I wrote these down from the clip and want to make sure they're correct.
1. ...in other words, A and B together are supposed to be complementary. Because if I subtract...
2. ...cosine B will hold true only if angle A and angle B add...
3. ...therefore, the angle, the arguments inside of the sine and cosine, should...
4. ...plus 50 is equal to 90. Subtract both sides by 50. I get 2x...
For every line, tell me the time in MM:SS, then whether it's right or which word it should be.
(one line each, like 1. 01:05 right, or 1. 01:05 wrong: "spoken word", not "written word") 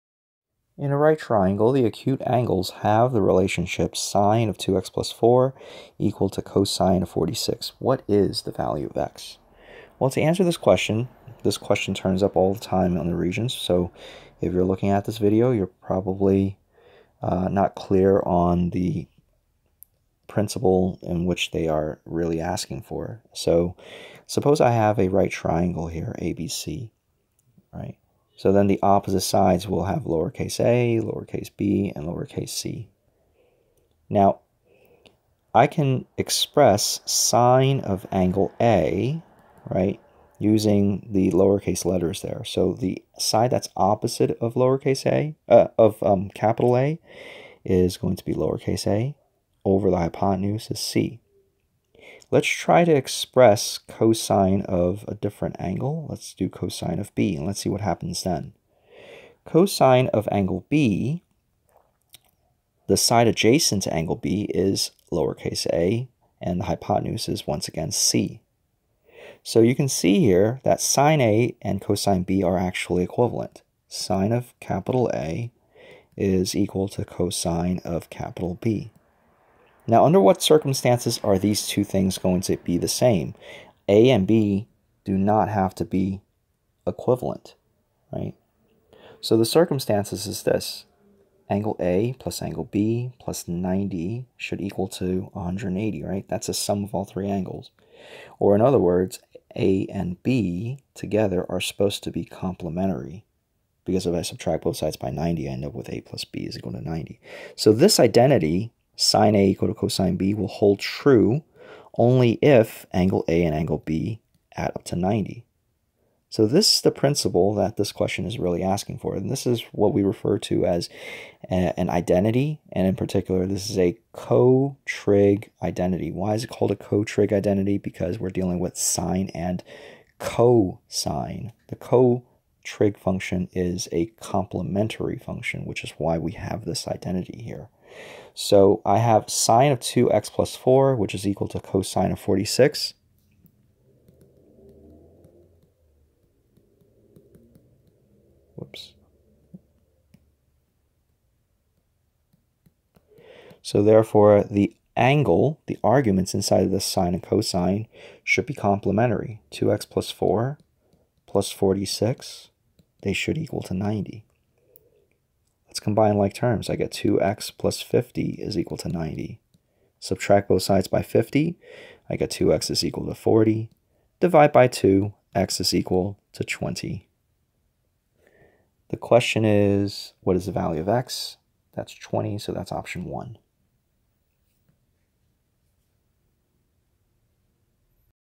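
1. 01:38 right
2. 01:49 right
3. 02:33 right
4. 02:47 right.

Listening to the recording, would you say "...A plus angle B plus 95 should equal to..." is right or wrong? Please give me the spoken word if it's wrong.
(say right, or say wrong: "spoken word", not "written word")
wrong: "90", not "95".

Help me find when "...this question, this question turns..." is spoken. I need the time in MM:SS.
00:10.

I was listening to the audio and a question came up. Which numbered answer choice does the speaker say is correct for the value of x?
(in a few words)
option 1.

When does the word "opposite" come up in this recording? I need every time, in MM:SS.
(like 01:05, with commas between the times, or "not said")
00:28, 00:43.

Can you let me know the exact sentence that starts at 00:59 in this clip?
Cosine of angle B, the side adjacent to angle B is lowercase a and the hypotenuse is once again C.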